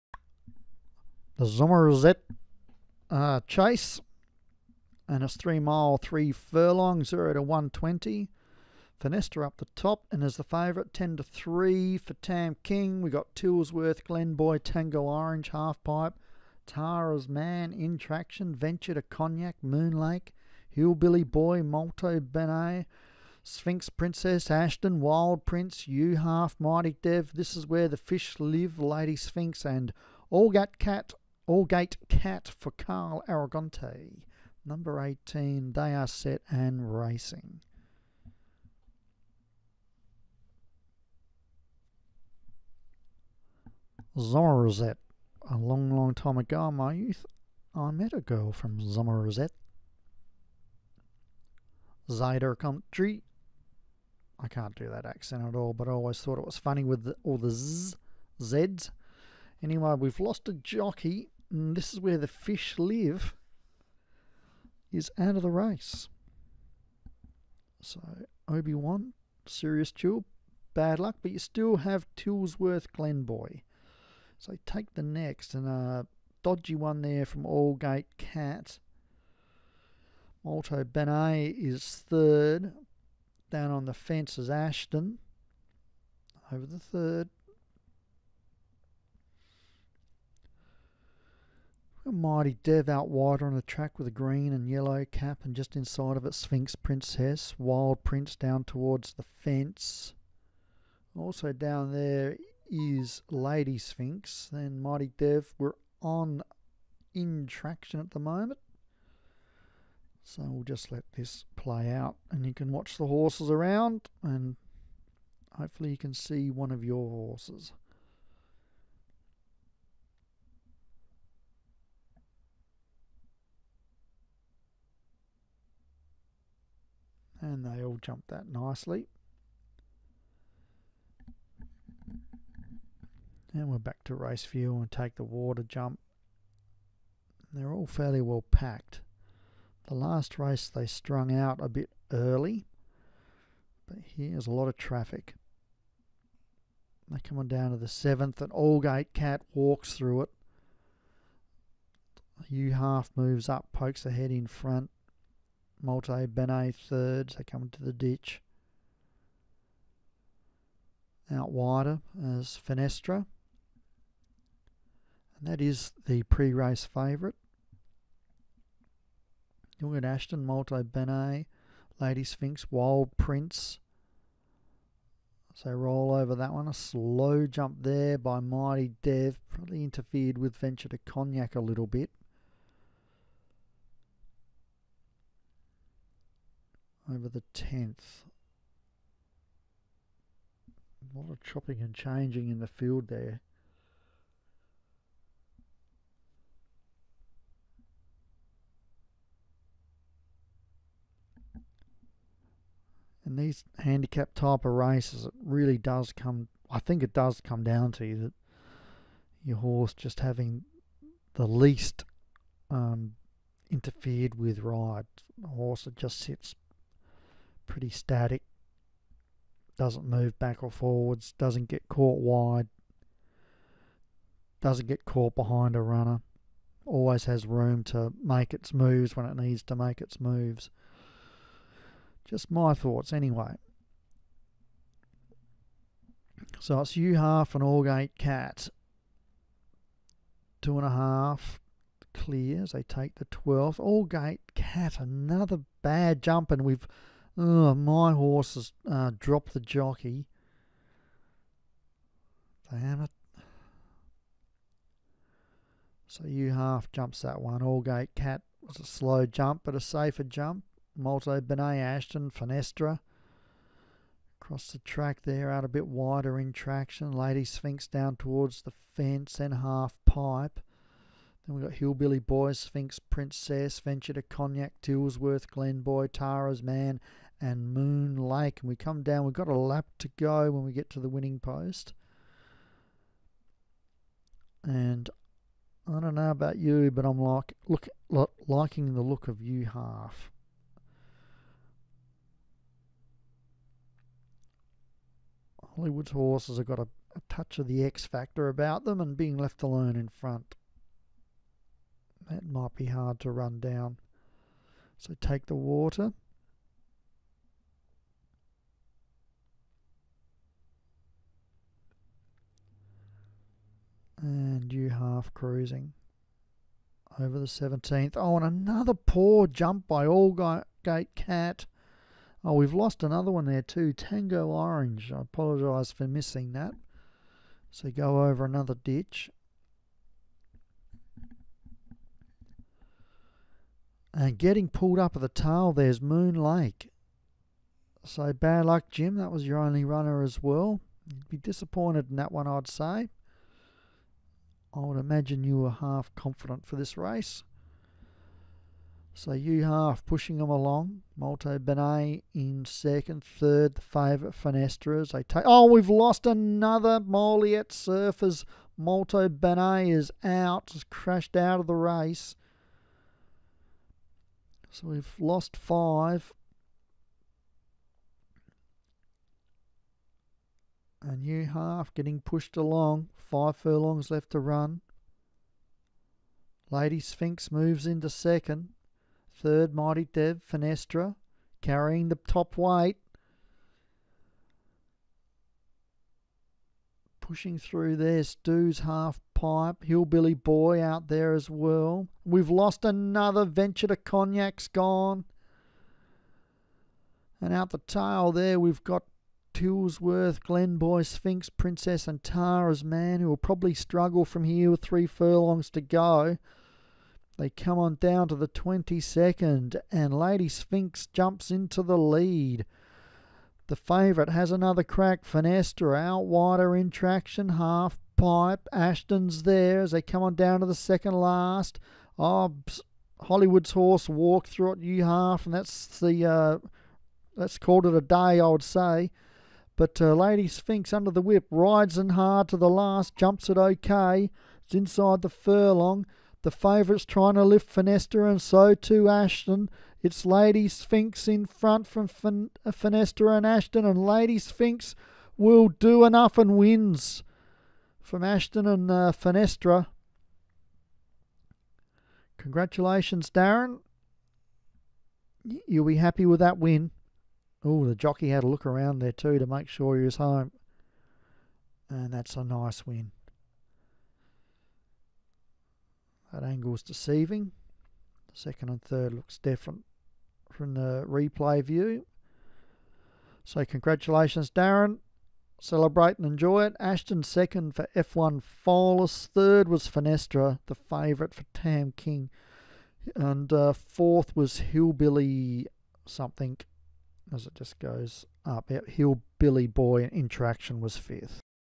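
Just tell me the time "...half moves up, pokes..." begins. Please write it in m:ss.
2:32.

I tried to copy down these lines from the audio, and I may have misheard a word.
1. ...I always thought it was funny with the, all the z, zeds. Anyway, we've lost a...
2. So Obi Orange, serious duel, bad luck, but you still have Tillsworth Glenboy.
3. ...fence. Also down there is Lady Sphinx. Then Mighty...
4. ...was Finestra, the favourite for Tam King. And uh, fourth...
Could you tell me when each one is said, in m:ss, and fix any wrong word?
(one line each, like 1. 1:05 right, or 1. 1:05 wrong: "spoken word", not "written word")
1. 0:55 right
2. 1:07 wrong: "Wan", not "Orange"
3. 1:39 right
4. 7:59 right.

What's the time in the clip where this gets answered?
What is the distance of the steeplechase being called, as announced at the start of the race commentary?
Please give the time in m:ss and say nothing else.
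0:05.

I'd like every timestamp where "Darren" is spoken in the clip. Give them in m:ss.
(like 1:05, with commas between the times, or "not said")
7:33, 7:54.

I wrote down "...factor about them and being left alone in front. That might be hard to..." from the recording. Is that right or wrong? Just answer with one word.
right.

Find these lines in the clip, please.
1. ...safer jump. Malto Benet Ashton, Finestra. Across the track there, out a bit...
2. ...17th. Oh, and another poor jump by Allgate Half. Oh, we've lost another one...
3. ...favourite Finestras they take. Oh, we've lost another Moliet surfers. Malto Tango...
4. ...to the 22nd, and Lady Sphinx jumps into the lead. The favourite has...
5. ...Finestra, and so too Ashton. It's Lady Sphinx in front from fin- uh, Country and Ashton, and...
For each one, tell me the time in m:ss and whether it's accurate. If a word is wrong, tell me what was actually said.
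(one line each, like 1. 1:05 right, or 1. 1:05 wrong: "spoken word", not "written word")
1. 4:19 right
2. 5:17 wrong: "Cat", not "Half"
3. 5:53 wrong: "Benet", not "Tango"
4. 6:48 right
5. 7:17 wrong: "Finestra", not "Country".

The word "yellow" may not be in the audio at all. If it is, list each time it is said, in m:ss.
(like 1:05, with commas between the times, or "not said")
1:34.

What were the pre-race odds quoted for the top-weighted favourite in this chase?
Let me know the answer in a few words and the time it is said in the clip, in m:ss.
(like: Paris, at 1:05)
10 to 3, at 0:10.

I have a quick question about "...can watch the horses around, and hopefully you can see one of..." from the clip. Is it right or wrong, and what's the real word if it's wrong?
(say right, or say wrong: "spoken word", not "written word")
right.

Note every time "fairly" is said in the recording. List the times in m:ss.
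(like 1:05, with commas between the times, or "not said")
2:17.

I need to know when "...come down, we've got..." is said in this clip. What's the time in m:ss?
4:38.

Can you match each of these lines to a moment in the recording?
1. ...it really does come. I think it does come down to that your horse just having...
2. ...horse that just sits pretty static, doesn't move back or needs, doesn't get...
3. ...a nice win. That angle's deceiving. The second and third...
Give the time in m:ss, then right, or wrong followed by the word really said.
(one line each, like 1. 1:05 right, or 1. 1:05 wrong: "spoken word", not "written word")
1. 3:25 right
2. 3:35 wrong: "forwards", not "needs"
3. 7:42 right.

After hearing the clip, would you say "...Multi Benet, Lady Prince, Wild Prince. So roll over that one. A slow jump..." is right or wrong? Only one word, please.
wrong.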